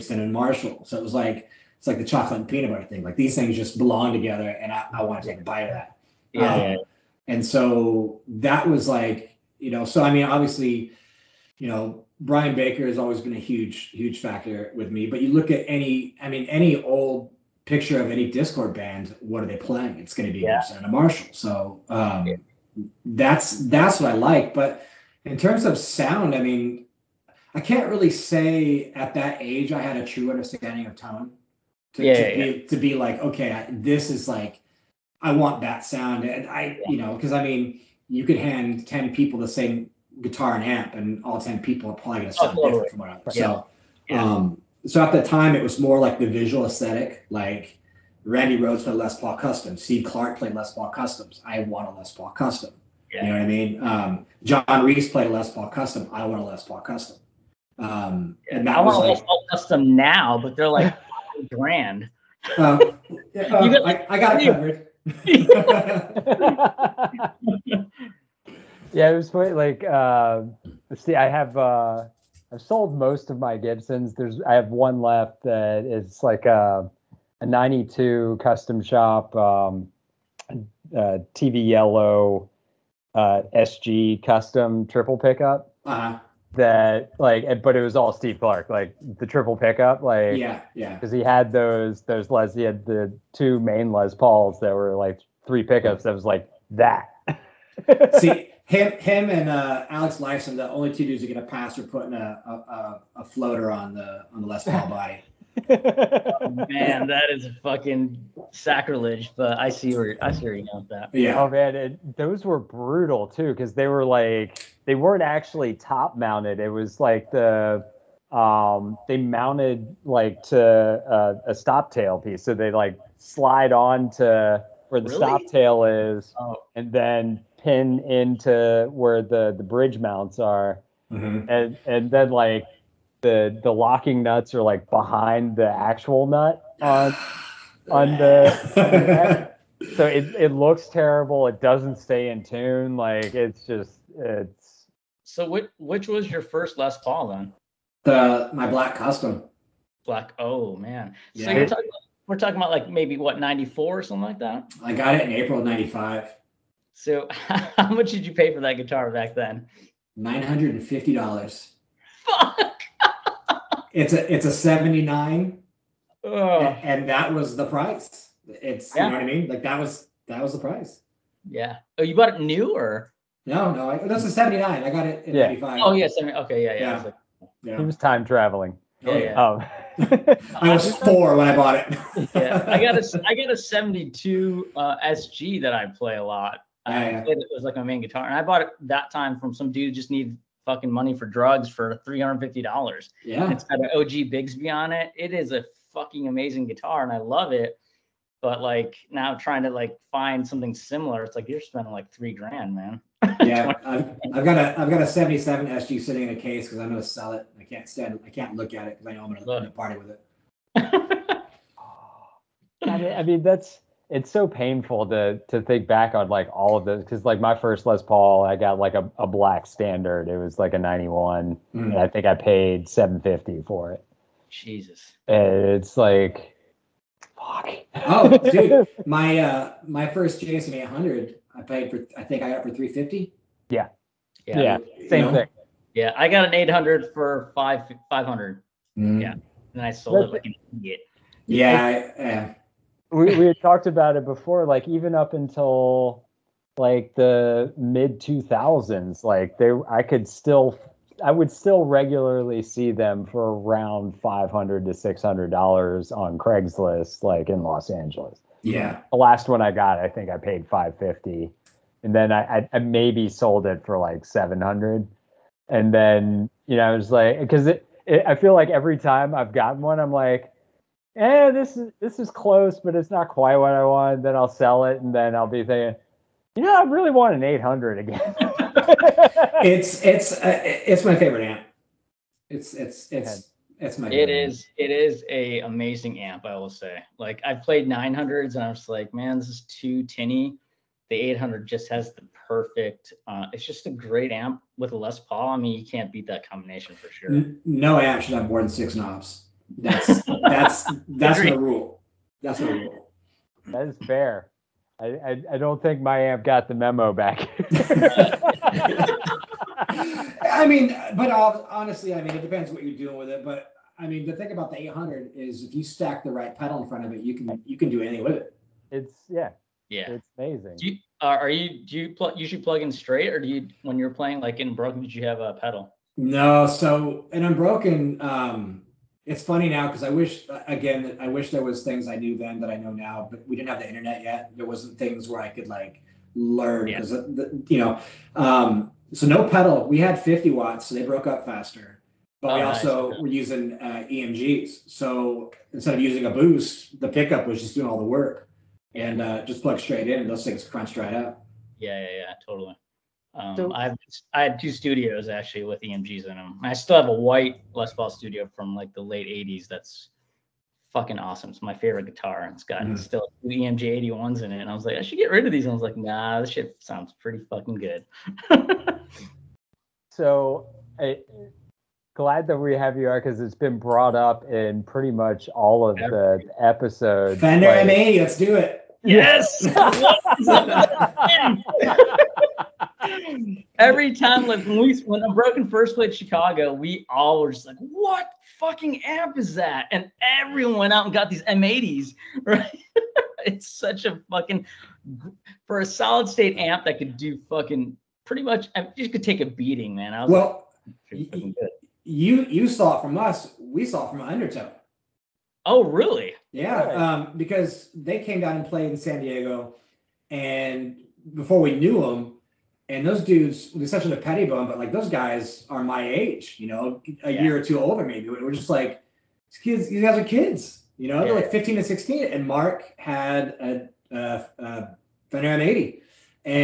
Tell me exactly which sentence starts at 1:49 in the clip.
But I see where I see where you got that.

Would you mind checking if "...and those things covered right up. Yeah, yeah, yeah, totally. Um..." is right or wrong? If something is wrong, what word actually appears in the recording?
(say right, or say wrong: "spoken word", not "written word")
wrong: "crunched", not "covered".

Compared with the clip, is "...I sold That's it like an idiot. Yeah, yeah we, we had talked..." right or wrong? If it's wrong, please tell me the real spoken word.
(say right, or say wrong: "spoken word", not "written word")
right.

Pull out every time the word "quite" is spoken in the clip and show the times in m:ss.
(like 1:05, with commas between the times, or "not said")
1:09, 4:33.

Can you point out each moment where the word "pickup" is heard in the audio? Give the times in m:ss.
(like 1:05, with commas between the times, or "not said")
1:25, 1:29, 1:35, 5:47.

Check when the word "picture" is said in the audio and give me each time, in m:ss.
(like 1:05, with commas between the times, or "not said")
0:17.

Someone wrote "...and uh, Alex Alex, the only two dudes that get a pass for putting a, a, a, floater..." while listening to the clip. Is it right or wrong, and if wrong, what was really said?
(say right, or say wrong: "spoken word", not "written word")
wrong: "Lifeson", not "Alex".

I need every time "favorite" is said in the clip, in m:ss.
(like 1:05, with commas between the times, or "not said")
4:41, 6:01.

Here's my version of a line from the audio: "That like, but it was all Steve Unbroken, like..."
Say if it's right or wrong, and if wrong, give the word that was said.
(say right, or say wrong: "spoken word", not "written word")
wrong: "Clark", not "Unbroken".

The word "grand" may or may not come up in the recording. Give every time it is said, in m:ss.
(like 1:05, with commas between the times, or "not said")
1:01, 3:22.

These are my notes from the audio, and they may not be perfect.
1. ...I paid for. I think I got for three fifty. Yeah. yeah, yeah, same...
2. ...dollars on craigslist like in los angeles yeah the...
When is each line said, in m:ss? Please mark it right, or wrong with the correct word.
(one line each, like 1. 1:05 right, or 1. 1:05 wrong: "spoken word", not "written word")
1. 3:51 right
2. 4:15 right.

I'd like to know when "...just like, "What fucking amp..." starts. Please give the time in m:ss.
6:27.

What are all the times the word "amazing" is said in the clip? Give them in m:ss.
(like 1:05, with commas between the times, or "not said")
3:16, 4:45, 5:20.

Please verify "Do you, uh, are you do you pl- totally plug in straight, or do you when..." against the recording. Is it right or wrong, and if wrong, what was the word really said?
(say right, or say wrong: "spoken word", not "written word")
wrong: "usually", not "totally".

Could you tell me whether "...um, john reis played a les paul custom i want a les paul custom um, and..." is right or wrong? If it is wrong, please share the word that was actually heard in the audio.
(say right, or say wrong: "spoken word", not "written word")
right.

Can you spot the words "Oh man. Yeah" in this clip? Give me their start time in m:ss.
2:30.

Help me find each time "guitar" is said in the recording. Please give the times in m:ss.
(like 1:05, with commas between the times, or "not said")
0:40, 2:38, 3:08, 3:16, 6:02.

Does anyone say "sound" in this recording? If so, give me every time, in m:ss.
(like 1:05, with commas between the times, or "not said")
0:25, 0:35, 0:42, 6:06.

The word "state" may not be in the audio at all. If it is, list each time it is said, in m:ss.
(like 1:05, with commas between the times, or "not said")
6:36.